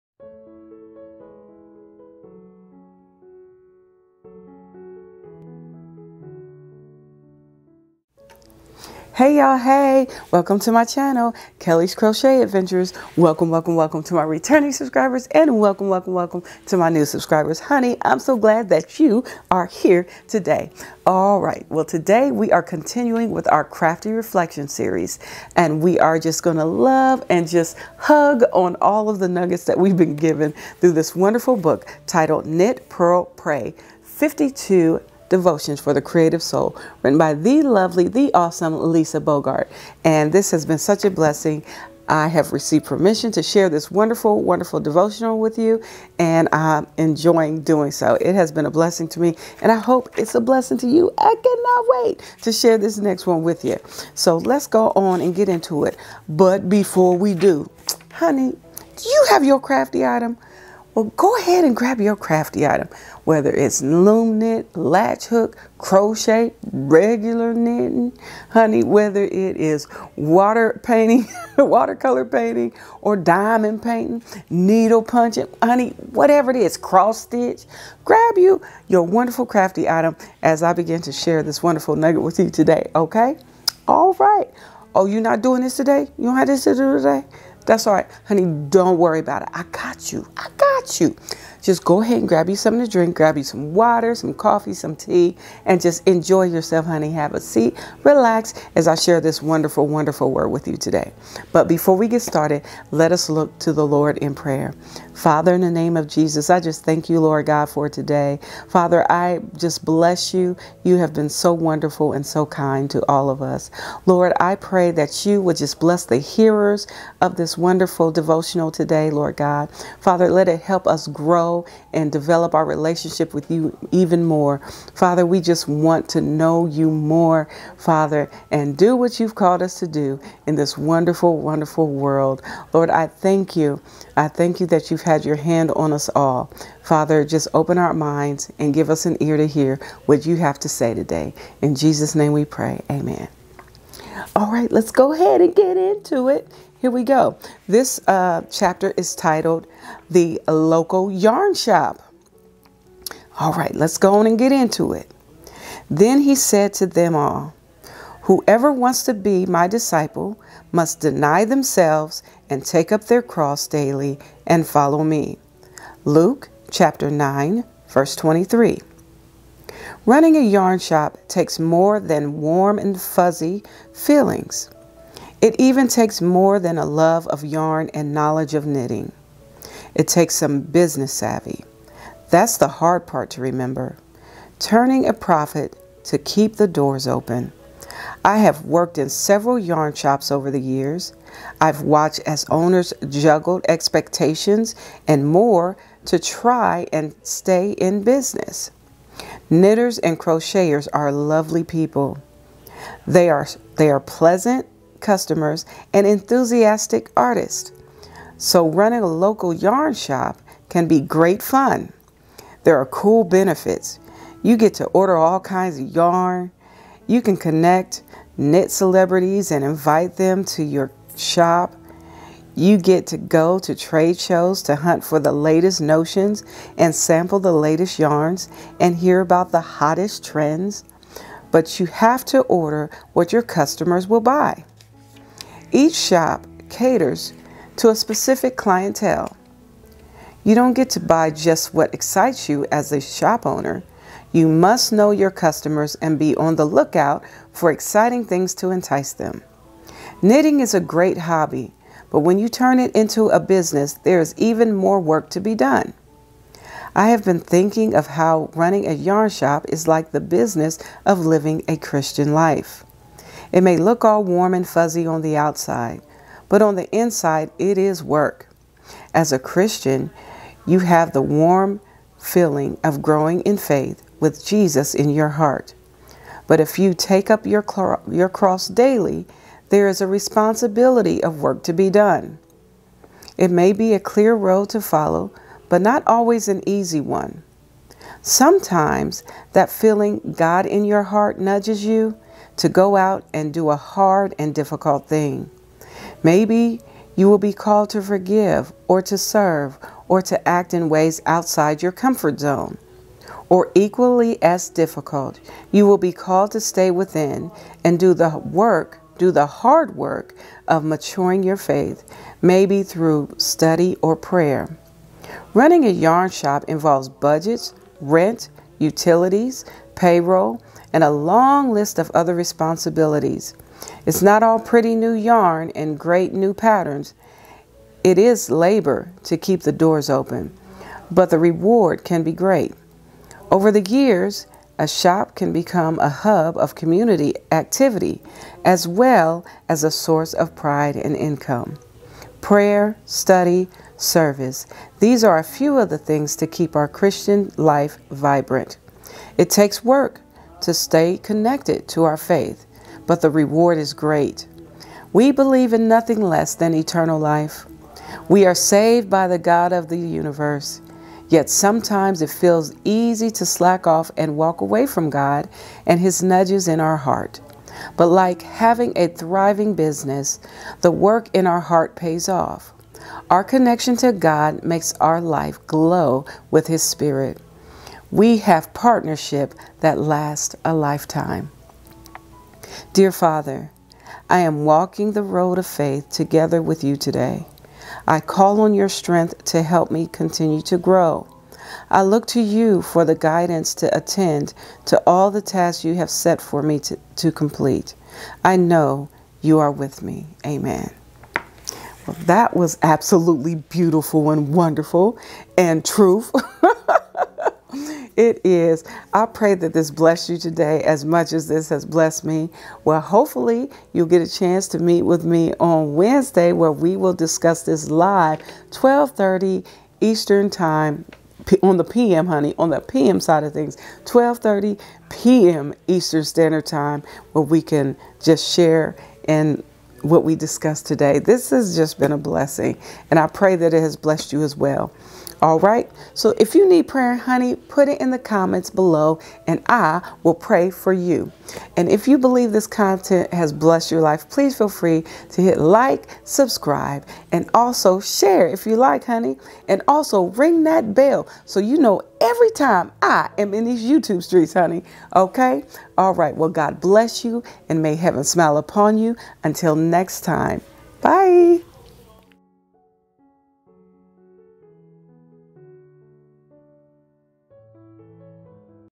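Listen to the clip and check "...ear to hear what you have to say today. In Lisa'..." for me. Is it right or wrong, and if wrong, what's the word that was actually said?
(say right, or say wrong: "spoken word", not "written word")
wrong: "Jesus", not "Lisa".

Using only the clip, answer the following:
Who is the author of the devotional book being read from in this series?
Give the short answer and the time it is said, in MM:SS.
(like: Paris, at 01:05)
Lisa Bogart, at 00:38.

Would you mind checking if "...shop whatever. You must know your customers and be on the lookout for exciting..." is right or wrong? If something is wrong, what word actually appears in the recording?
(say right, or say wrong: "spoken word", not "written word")
wrong: "owner", not "whatever".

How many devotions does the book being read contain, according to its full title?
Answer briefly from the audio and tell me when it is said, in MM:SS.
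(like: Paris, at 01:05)
52, at 00:34.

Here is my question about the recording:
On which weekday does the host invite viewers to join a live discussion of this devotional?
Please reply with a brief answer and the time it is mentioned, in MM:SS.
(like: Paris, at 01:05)
Wednesday, at 06:55.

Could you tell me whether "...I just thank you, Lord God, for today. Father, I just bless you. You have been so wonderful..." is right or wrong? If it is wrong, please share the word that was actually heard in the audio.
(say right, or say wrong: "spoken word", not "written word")
right.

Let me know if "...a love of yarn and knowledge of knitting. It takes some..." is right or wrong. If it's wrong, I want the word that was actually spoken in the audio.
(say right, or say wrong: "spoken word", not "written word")
right.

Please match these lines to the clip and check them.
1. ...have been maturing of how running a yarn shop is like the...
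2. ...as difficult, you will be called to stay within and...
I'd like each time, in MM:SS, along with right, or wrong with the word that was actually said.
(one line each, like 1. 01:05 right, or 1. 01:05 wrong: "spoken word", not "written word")
1. 04:17 wrong: "thinking", not "maturing"
2. 05:04 right.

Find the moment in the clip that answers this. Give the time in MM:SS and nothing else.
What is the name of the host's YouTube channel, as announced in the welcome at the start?
00:11.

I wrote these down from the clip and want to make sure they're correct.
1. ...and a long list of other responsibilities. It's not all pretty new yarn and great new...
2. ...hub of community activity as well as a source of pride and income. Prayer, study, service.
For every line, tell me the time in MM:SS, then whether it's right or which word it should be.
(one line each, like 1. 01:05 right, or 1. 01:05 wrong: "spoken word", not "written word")
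1. 05:20 right
2. 05:36 right.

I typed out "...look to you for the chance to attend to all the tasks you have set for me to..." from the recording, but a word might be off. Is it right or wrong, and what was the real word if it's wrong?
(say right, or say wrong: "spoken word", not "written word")
wrong: "guidance", not "chance".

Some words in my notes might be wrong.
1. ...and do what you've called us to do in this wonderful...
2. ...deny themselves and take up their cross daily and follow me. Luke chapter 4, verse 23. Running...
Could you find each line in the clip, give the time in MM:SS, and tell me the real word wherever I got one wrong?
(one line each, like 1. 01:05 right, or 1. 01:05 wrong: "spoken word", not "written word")
1. 02:08 right
2. 02:40 wrong: "9", not "4".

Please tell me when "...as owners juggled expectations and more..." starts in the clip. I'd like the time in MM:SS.
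03:12.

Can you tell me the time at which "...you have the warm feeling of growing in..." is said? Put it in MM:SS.
04:30.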